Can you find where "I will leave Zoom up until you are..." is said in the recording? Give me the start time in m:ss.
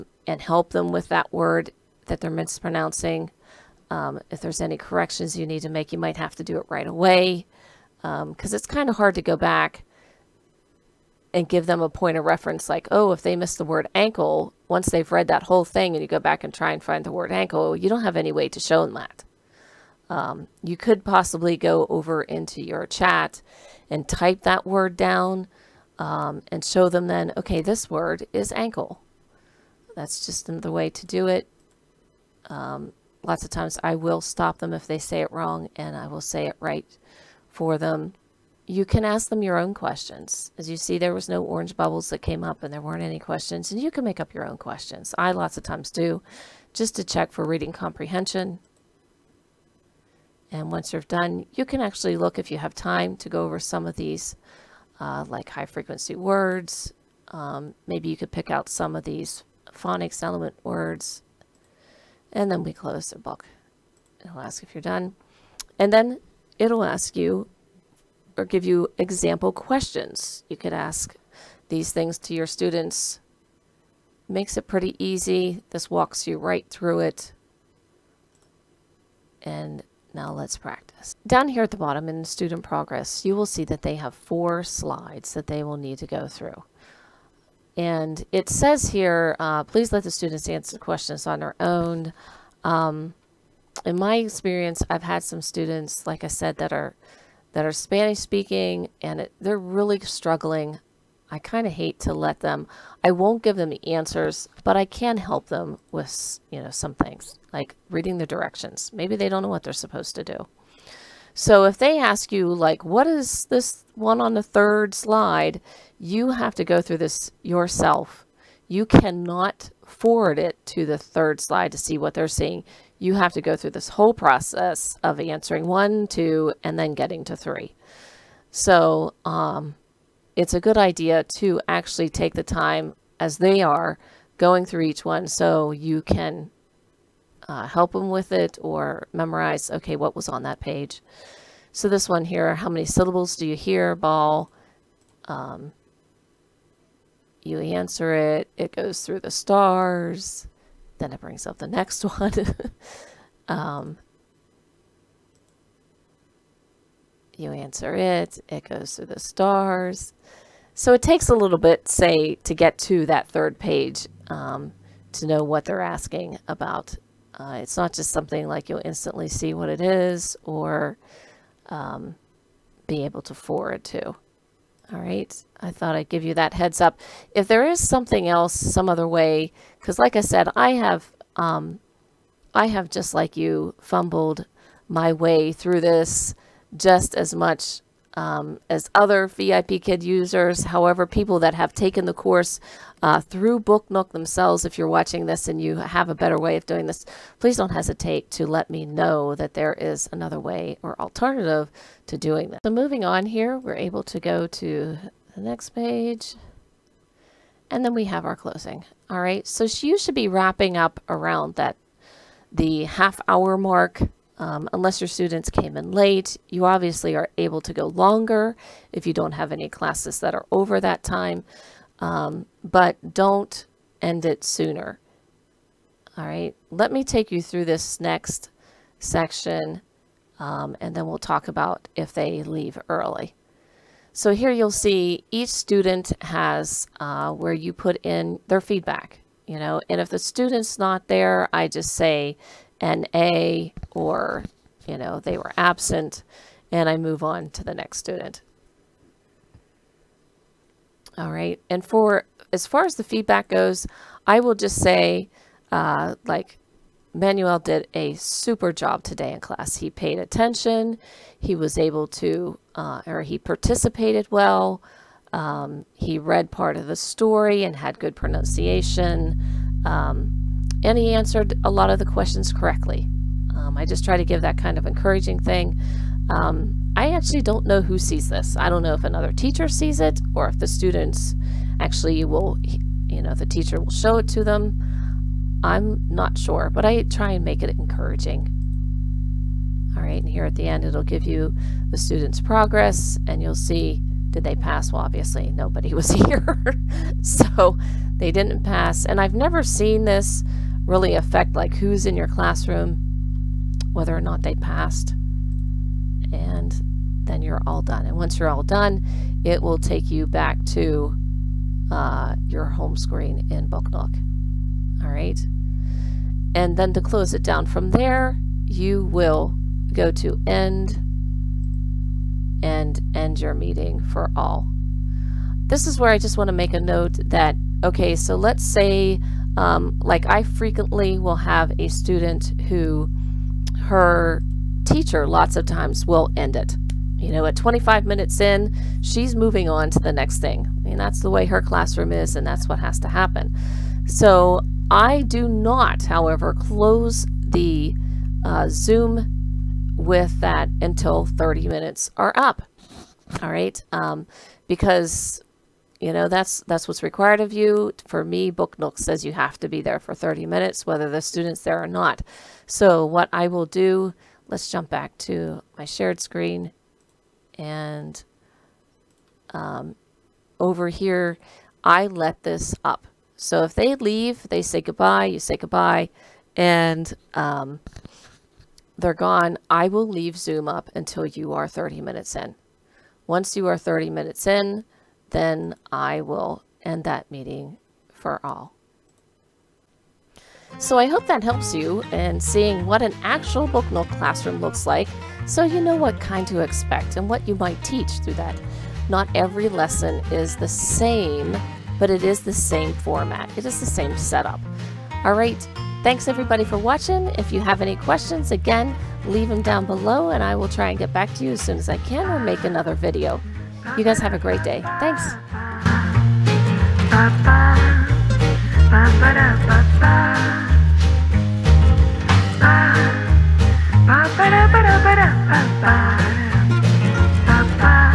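6:19.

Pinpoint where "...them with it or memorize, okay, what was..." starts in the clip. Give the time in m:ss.
2:17.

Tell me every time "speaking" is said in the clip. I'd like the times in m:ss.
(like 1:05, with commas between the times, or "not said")
1:38.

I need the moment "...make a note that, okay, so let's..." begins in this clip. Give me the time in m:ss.
5:26.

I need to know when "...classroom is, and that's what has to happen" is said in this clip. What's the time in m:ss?
5:41.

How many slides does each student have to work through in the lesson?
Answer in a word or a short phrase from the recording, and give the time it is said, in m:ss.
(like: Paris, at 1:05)
4, at 1:24.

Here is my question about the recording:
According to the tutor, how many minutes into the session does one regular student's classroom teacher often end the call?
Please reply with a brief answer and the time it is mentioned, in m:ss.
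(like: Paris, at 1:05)
25 minutes, at 5:37.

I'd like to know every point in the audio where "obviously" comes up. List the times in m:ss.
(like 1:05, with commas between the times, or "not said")
3:36, 4:55.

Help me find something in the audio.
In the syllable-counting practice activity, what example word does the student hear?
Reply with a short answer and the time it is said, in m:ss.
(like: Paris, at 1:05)
ball, at 2:23.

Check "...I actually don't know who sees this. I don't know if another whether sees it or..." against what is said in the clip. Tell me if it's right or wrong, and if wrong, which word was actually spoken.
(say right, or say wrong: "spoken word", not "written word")
wrong: "teacher", not "whether".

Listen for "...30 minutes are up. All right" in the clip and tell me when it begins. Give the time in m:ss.
5:51.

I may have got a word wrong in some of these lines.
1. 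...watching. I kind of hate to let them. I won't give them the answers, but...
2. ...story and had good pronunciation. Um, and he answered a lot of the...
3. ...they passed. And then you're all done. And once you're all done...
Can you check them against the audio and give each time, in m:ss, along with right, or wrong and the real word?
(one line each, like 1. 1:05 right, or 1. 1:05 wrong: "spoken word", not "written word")
1. 1:39 wrong: "struggling", not "watching"
2. 4:26 right
3. 5:04 right.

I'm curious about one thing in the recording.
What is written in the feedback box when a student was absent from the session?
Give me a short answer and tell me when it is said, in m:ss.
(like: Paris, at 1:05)
NA, at 4:02.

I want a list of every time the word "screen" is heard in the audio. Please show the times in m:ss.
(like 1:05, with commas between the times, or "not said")
5:12, 6:06.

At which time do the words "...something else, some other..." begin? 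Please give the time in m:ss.
2:57.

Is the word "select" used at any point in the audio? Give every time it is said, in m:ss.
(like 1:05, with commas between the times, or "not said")
not said.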